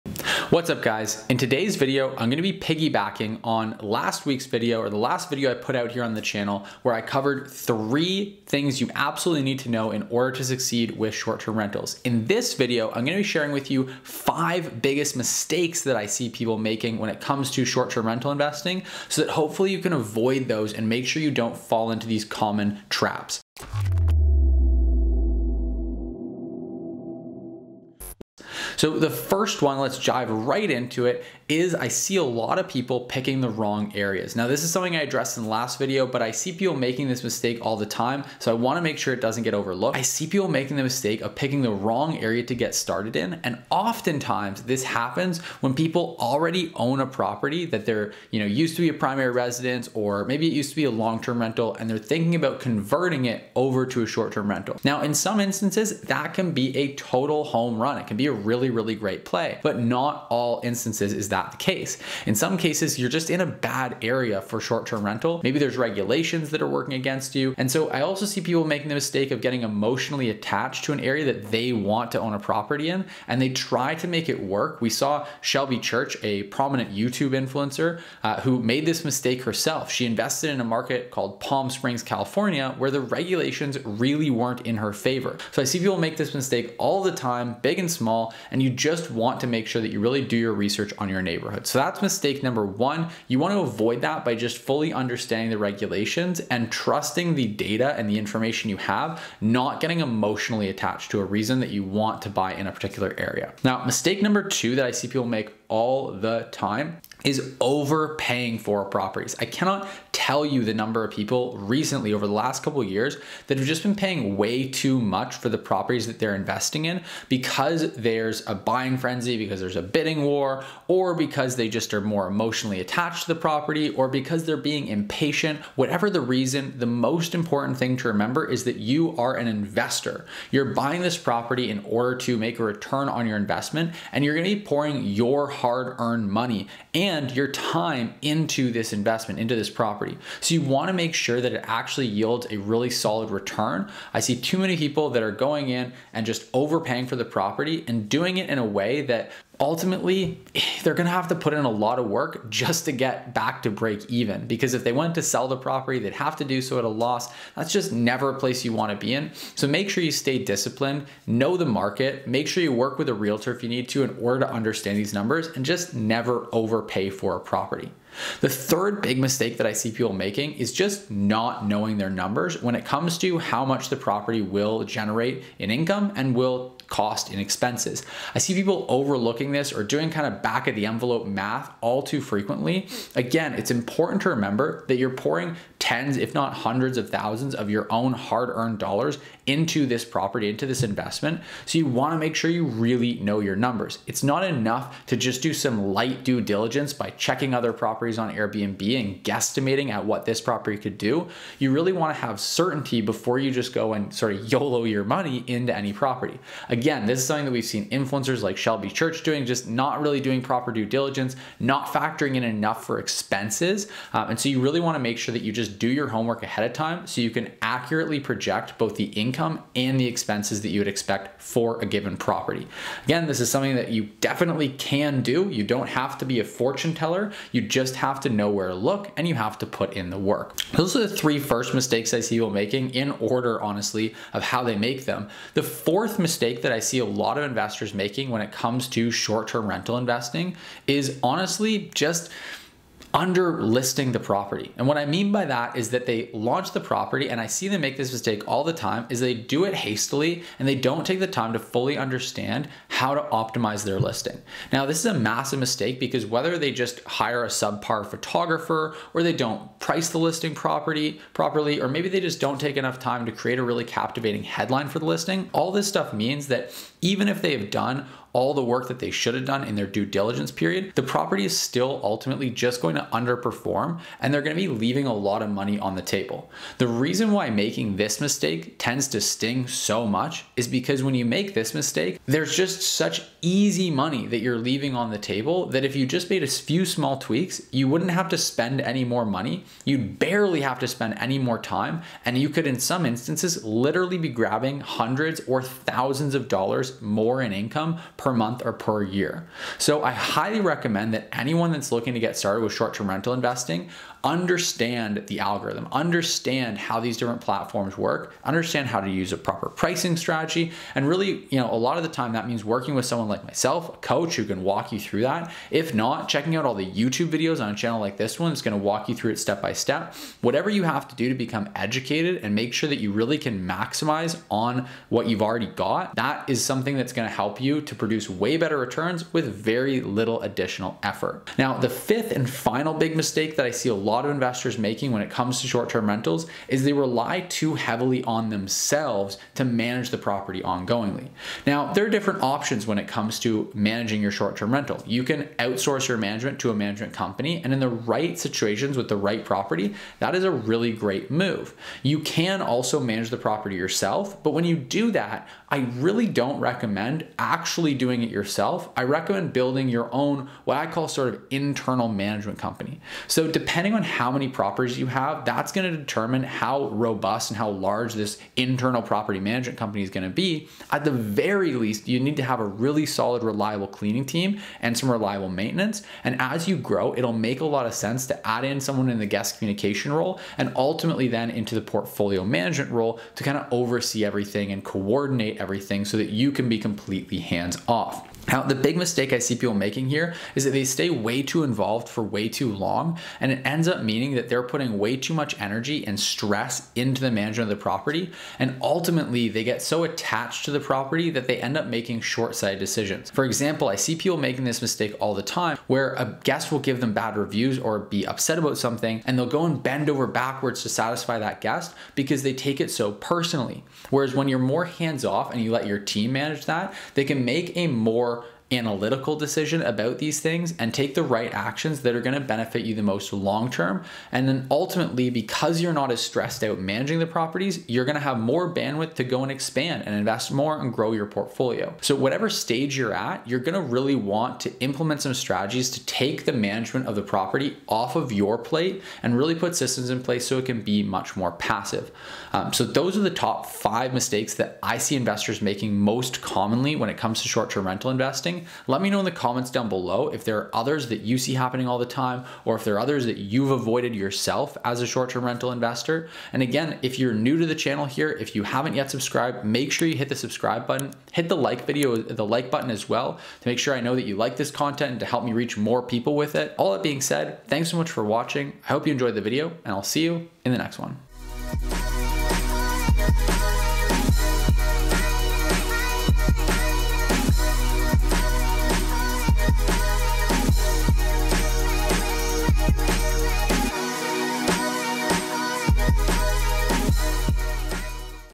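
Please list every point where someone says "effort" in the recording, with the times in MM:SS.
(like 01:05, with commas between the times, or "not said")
05:31.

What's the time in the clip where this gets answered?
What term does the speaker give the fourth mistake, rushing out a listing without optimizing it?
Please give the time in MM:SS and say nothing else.
04:03.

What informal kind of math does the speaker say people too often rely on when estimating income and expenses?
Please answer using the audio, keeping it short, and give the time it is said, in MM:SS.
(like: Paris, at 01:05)
Back of the envelope, at 03:00.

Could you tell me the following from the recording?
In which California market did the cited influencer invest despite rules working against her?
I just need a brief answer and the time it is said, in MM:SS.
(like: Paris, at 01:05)
Palm Springs, at 01:21.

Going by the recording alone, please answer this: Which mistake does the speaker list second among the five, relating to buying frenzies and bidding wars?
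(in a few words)
Overpaying for properties.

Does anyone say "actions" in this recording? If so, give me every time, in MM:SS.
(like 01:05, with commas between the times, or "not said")
07:01.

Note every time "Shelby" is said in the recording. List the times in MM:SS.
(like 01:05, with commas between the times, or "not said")
01:15, 03:28.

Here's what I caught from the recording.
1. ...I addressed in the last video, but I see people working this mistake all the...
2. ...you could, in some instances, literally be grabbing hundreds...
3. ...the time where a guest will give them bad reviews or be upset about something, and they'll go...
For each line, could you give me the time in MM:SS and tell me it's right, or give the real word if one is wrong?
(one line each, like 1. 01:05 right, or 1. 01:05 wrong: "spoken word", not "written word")
1. 00:34 wrong: "making", not "working"
2. 04:52 right
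3. 06:45 right.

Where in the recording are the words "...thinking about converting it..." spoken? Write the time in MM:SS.
00:51.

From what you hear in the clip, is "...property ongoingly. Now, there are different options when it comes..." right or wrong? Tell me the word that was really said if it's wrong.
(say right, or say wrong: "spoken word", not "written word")
right.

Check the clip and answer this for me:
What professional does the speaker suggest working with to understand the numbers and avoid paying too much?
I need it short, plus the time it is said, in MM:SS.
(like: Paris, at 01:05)
A realtor, at 02:43.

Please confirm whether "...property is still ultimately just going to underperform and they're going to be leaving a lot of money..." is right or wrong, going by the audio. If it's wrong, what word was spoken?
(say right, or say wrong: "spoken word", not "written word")
right.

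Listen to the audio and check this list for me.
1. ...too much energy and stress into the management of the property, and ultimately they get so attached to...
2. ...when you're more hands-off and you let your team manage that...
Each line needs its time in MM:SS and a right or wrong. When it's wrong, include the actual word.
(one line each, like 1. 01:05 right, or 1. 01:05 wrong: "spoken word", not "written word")
1. 06:35 right
2. 06:54 right.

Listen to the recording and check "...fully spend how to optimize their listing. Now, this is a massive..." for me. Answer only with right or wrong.
wrong.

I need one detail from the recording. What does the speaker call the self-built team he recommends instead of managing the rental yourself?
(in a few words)
Internal management company.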